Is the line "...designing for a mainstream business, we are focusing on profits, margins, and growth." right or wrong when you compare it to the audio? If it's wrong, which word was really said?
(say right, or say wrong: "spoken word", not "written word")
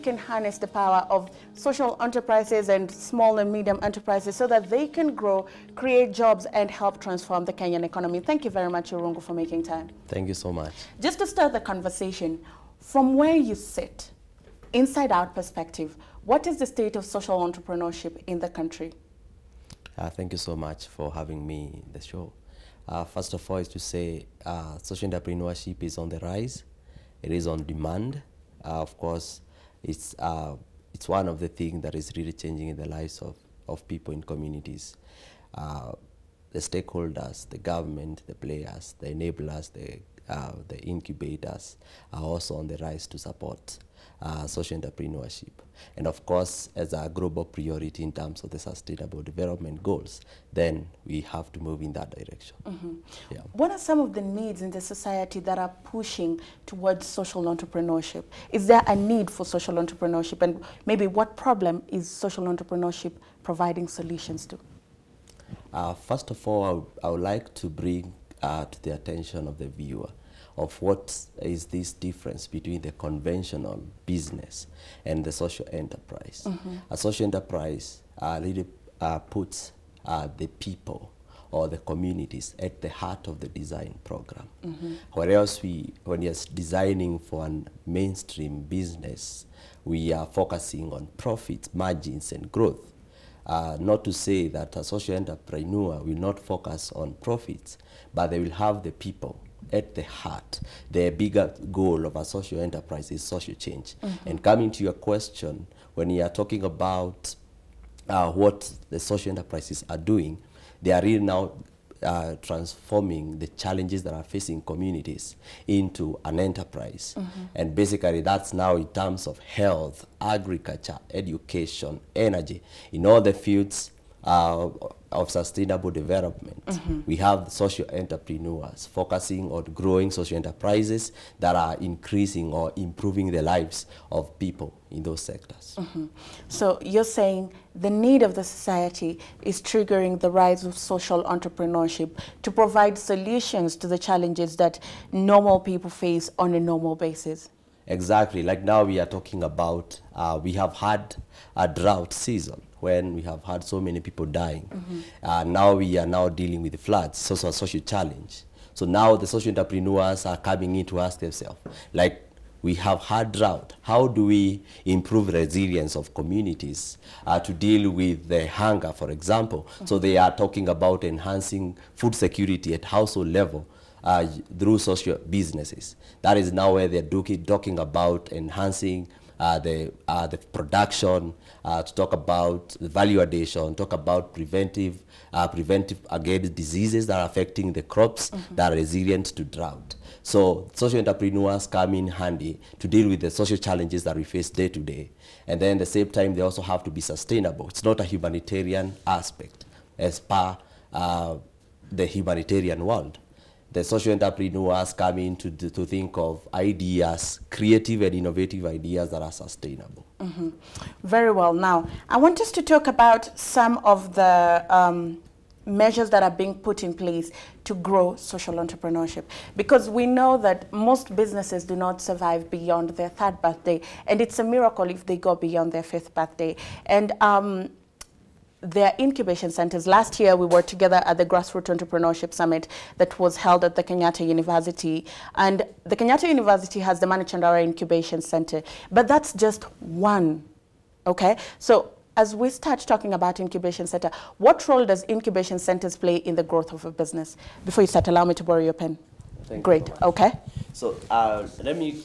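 right.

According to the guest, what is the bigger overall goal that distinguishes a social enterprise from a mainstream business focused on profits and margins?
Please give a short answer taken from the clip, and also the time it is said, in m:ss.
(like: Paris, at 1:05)
Social change, at 1:43.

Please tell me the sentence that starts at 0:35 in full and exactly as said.
Uh, the stakeholders, the government, the players, the enablers, the, the incubators are also on the rise to support uh, social entrepreneurship.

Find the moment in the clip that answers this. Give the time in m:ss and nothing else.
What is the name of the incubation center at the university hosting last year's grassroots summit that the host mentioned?
3:57.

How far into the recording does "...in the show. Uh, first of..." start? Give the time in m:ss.
0:21.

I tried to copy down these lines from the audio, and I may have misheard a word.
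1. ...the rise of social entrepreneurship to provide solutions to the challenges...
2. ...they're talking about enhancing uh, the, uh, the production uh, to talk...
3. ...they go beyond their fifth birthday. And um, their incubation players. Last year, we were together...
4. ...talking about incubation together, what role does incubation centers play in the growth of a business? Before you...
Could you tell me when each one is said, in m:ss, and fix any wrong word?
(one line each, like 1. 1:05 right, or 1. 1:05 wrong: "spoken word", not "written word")
1. 2:20 right
2. 2:57 right
3. 3:45 wrong: "centers", not "players"
4. 4:02 wrong: "center", not "together".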